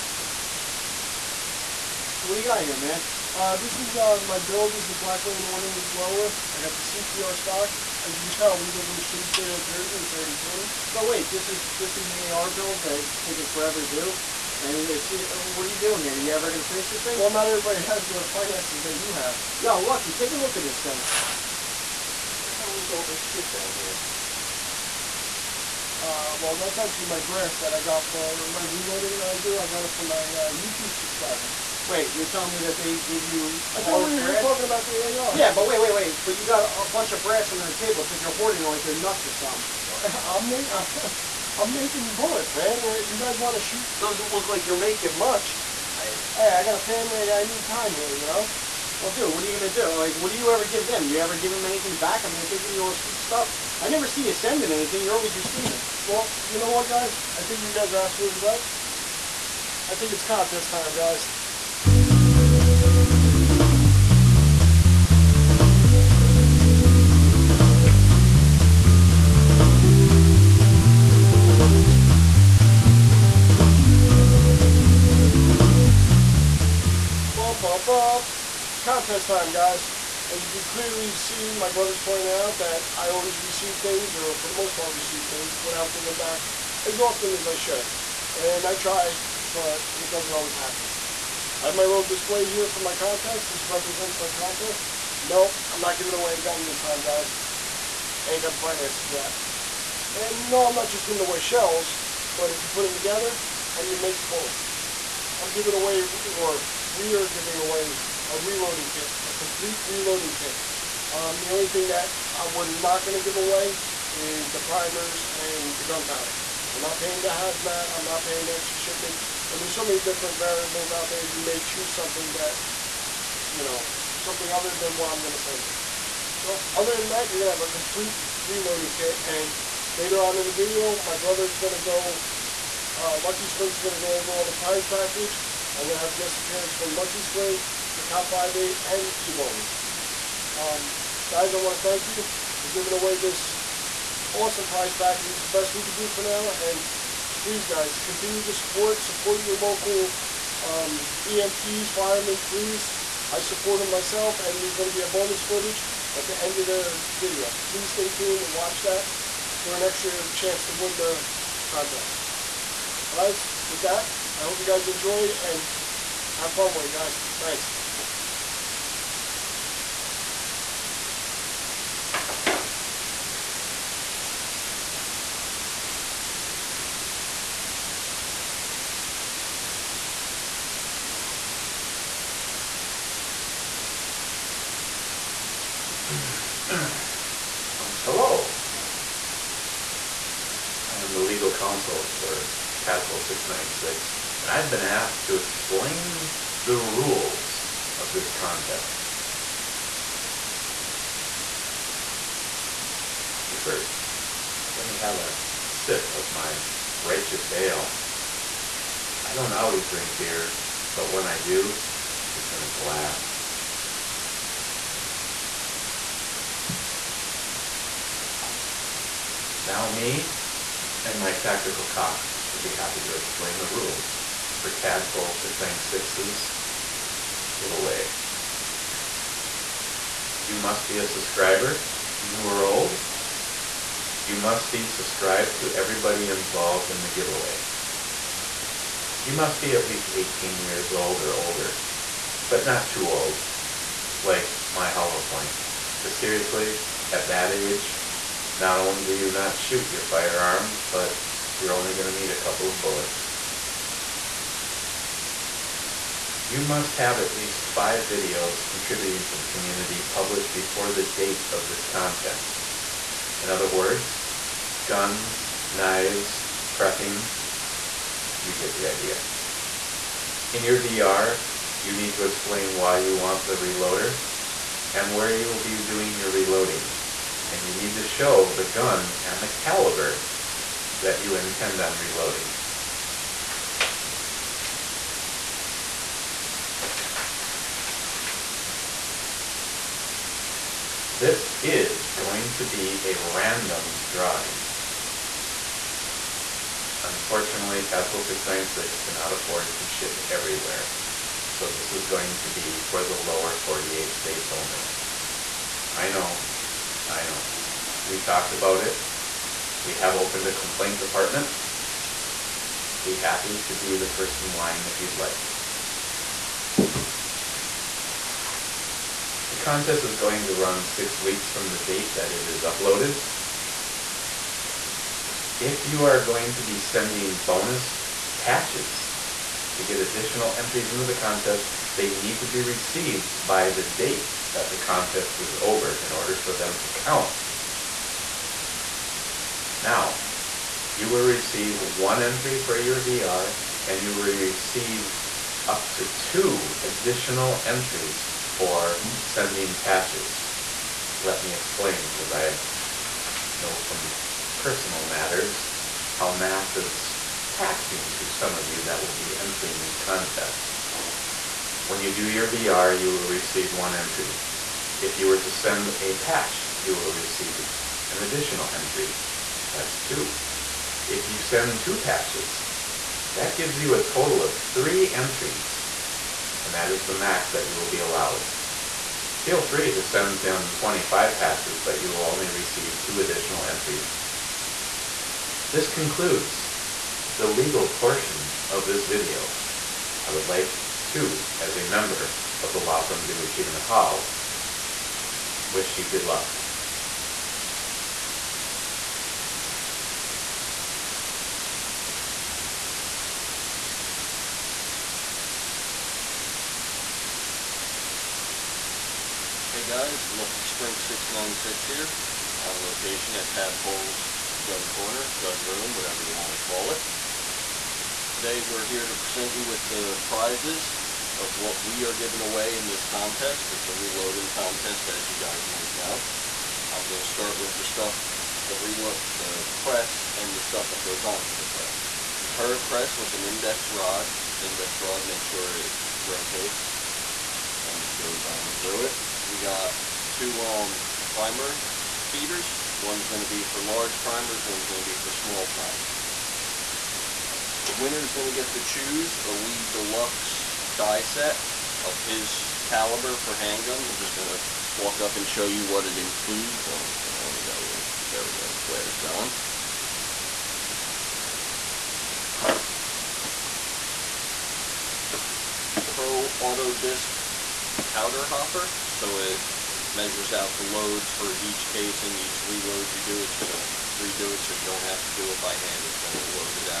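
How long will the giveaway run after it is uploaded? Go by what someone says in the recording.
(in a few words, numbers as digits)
6 weeks.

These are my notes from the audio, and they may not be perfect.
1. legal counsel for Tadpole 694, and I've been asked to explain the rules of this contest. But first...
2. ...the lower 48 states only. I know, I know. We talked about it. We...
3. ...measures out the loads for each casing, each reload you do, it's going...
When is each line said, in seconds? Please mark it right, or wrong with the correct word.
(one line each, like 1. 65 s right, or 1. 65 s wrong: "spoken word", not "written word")
1. 191 s wrong: "696", not "694"
2. 303 s right
3. 470 s right.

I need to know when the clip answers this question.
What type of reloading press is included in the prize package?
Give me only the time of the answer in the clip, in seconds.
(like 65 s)
432 s.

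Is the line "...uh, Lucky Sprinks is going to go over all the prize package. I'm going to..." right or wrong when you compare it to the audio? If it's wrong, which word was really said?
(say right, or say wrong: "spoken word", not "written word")
right.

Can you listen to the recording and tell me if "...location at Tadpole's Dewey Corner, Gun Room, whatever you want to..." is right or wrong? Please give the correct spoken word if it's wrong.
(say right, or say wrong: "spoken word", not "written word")
wrong: "Gun", not "Dewey".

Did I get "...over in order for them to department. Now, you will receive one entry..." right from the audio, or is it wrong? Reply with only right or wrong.
wrong.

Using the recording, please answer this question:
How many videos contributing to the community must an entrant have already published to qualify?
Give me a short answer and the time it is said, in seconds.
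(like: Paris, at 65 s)
5, at 257 s.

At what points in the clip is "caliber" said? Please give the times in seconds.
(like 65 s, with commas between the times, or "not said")
279 s, 452 s.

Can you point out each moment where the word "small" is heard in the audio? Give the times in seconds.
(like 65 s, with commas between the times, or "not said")
445 s.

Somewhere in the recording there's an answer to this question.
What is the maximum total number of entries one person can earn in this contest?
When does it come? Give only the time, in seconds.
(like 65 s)
374 s.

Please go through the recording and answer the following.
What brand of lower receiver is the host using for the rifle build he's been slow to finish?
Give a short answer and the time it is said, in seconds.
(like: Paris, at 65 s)
Black Rain Ordnance, at 4 s.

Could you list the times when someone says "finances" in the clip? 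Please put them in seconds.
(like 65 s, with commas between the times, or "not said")
18 s, 98 s.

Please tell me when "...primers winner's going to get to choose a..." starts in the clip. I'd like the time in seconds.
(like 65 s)
445 s.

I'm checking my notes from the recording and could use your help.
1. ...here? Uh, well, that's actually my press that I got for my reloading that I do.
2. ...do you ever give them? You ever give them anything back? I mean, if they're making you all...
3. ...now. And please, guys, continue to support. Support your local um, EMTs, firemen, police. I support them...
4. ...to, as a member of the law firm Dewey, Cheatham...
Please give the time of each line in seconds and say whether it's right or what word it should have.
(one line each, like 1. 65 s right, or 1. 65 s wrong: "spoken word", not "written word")
1. 23 s wrong: "brass", not "press"
2. 50 s wrong: "giving", not "making"
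3. 146 s right
4. 391 s right.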